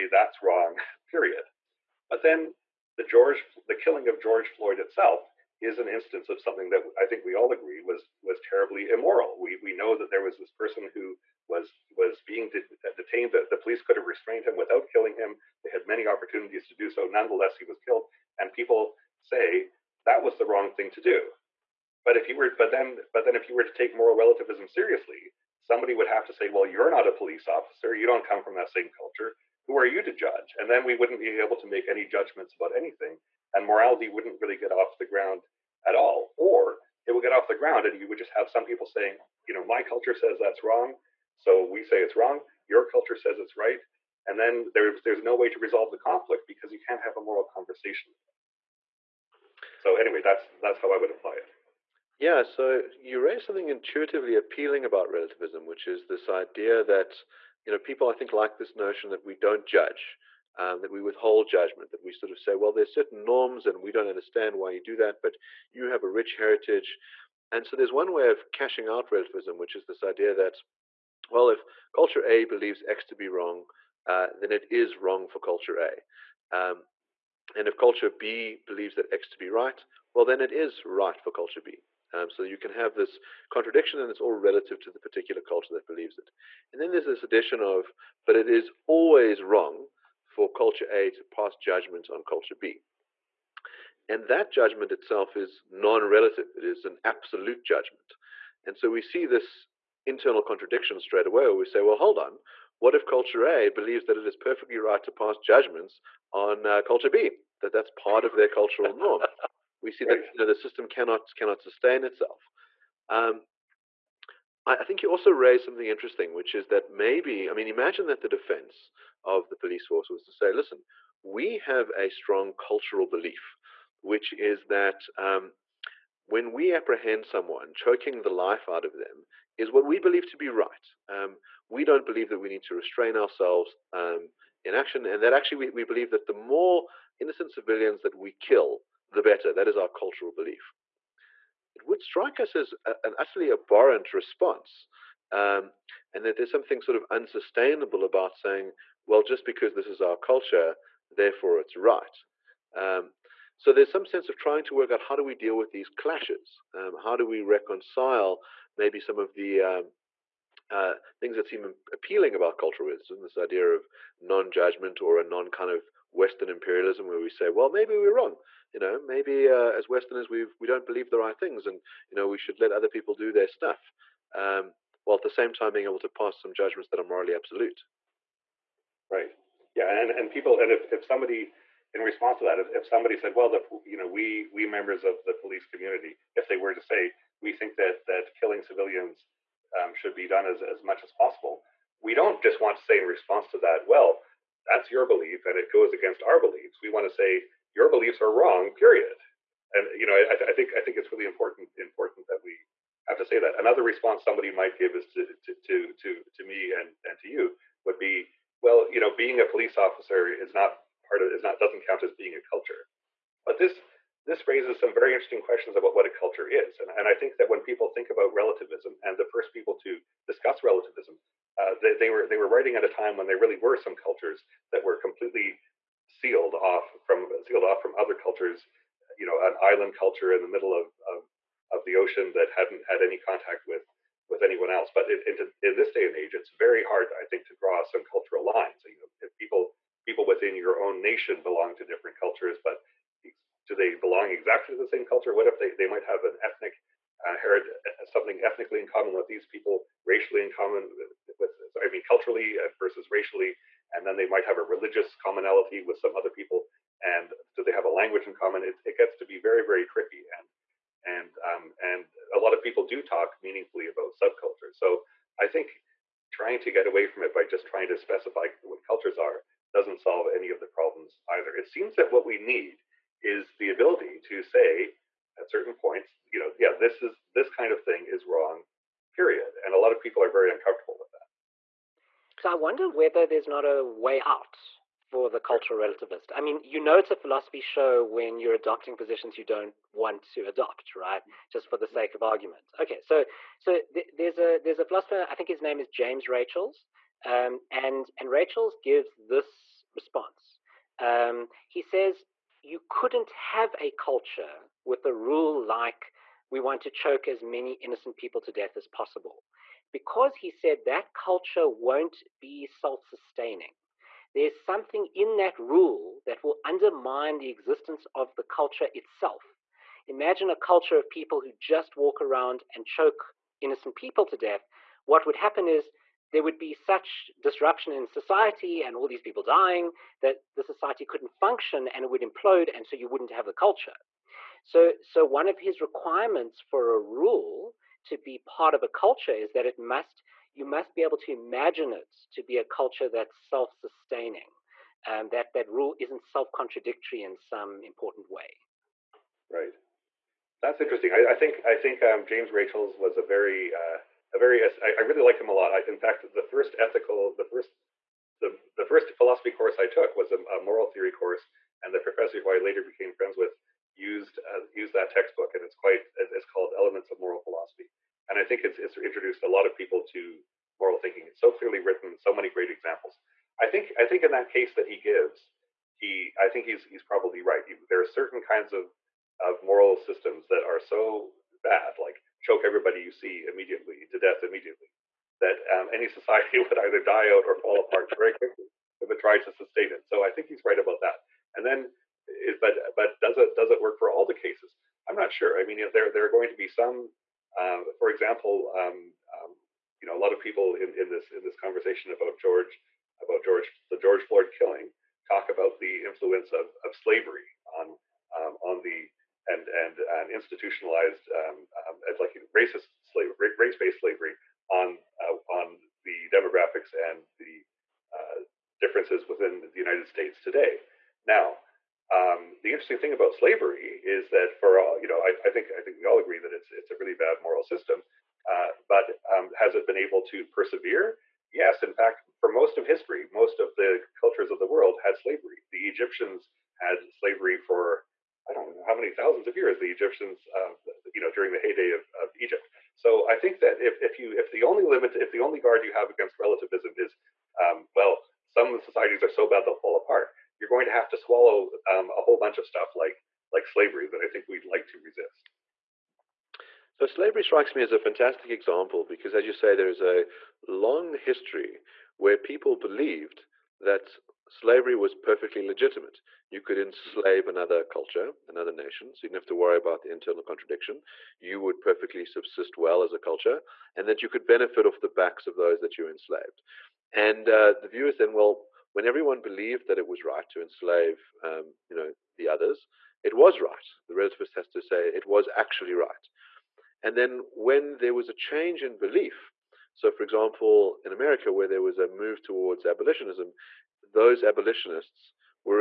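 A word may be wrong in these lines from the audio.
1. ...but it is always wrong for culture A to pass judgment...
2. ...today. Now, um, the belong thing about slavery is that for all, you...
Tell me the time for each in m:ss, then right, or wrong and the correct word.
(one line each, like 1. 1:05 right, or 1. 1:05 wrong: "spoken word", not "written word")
1. 1:28 right
2. 7:00 wrong: "interesting", not "belong".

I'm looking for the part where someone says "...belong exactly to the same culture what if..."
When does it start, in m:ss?
4:03.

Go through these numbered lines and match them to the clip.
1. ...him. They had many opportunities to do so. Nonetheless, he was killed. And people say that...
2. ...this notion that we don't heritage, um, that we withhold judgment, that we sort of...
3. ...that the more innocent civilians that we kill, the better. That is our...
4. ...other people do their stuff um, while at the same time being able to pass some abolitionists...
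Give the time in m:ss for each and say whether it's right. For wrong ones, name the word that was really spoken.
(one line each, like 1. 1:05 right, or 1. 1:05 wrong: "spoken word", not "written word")
1. 0:15 right
2. 0:58 wrong: "judge", not "heritage"
3. 2:16 right
4. 2:52 wrong: "judgments", not "abolitionists".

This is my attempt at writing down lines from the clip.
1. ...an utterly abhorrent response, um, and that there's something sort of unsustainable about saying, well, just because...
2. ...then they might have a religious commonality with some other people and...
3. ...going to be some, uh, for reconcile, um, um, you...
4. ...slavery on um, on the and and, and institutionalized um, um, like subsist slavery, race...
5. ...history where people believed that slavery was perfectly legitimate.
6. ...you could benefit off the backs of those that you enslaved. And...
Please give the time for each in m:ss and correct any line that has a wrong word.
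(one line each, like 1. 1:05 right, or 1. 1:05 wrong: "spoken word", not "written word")
1. 2:23 right
2. 4:14 right
3. 6:36 wrong: "example", not "reconcile"
4. 6:46 wrong: "racist", not "subsist"
5. 7:41 right
6. 7:54 right.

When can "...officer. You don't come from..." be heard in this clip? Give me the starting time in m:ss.
0:27.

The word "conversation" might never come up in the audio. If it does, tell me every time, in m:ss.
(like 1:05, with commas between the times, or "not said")
0:47, 6:41.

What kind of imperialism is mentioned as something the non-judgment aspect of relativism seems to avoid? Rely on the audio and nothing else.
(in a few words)
Western imperialism.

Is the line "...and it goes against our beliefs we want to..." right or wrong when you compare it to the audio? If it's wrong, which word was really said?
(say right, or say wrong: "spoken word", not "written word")
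right.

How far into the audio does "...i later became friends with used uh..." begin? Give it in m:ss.
6:02.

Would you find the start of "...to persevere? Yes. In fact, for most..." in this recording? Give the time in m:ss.
7:10.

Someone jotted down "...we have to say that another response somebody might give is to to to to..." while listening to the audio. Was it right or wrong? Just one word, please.
right.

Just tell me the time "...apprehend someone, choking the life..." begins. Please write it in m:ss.
2:06.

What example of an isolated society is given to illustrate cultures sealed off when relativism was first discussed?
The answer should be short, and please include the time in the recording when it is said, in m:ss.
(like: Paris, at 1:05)
an island culture, at 3:49.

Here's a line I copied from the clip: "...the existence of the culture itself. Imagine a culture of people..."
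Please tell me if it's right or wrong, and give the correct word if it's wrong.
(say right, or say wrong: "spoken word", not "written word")
right.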